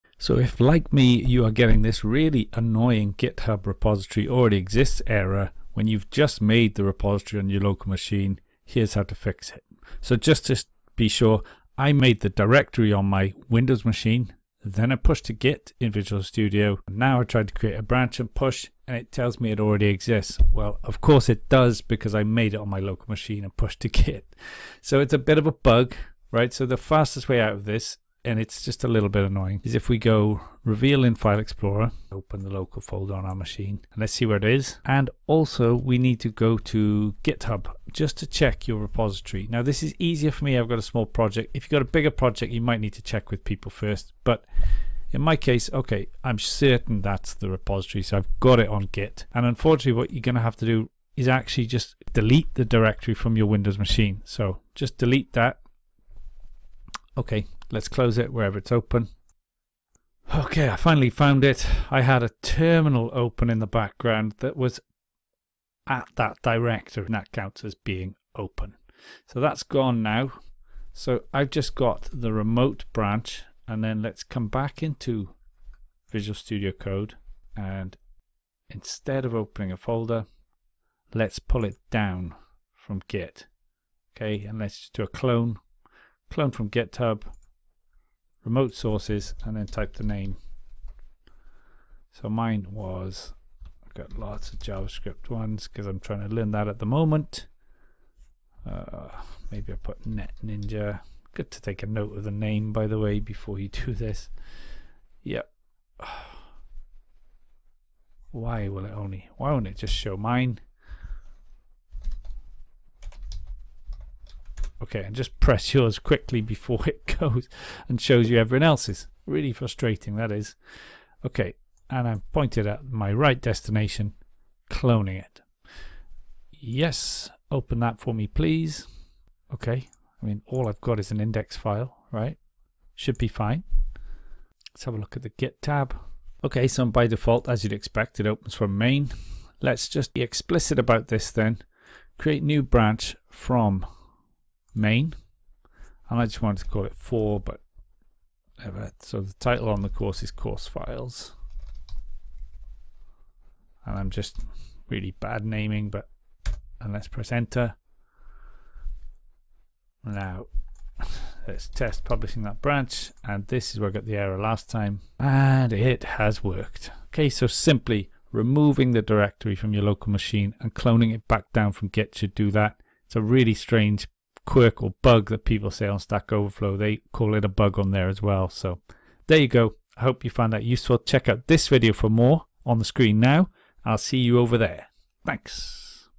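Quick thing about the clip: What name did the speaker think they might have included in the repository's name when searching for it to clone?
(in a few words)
Net Ninja.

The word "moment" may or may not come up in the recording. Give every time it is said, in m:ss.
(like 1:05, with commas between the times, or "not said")
1:36.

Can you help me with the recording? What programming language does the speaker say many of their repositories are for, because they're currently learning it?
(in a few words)
JavaScript.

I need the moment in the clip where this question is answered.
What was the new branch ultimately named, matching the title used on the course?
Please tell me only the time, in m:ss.
2:30.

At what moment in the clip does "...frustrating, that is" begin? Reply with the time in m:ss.
1:59.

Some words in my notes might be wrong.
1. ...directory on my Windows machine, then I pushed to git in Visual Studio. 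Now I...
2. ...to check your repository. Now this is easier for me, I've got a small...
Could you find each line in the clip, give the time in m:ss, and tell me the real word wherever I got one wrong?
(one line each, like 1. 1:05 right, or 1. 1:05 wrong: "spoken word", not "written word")
1. 0:12 right
2. 0:38 right.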